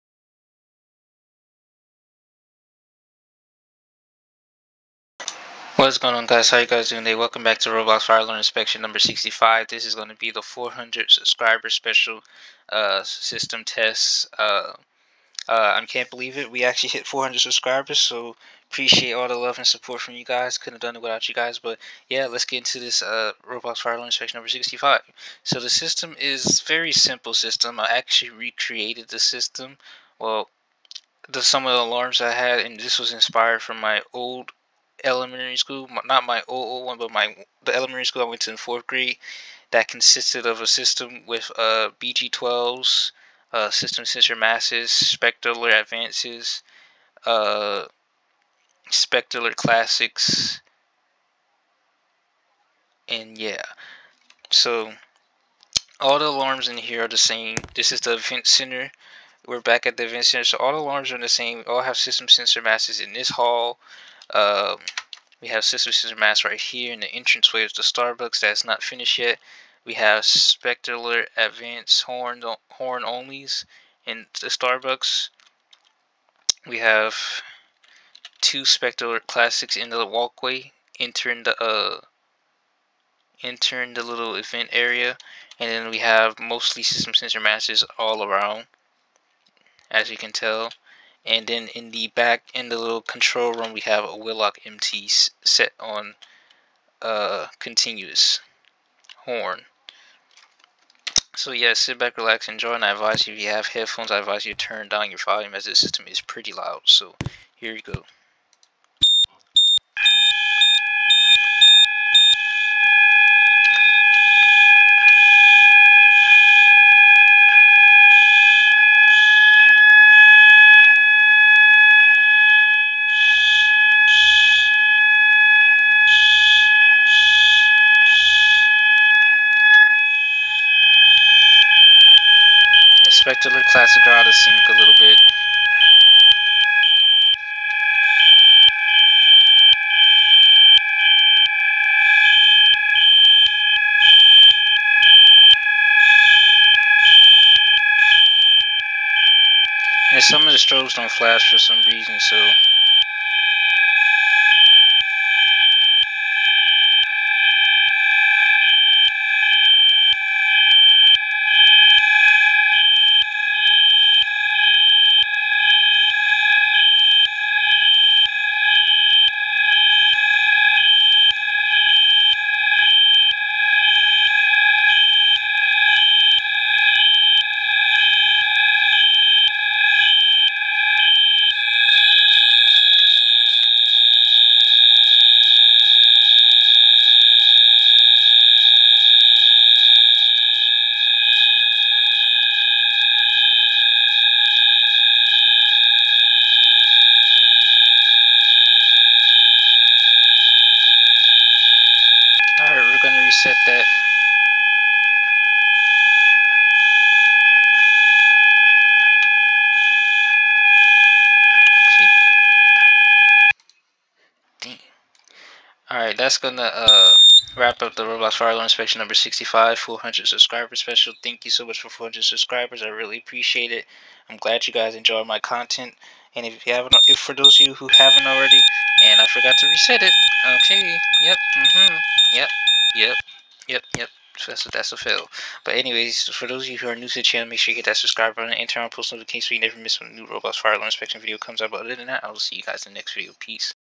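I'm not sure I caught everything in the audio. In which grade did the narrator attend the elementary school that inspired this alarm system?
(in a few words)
fourth grade.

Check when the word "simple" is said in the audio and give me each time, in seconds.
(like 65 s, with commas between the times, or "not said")
26 s.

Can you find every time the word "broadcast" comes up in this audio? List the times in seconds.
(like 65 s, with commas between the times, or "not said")
not said.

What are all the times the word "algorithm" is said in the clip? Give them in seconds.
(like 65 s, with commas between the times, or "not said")
not said.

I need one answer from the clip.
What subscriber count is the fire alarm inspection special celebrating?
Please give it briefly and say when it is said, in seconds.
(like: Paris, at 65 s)
400, at 10 s.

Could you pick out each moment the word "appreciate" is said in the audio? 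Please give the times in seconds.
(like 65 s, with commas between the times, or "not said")
18 s, 223 s.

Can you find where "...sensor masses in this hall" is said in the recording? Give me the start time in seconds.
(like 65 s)
62 s.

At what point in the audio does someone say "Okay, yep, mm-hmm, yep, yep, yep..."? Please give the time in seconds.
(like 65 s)
230 s.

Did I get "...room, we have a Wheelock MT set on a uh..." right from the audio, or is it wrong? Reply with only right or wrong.
right.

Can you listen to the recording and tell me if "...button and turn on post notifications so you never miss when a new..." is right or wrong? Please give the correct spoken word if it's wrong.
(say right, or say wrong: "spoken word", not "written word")
right.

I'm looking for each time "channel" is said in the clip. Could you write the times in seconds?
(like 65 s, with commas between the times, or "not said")
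237 s.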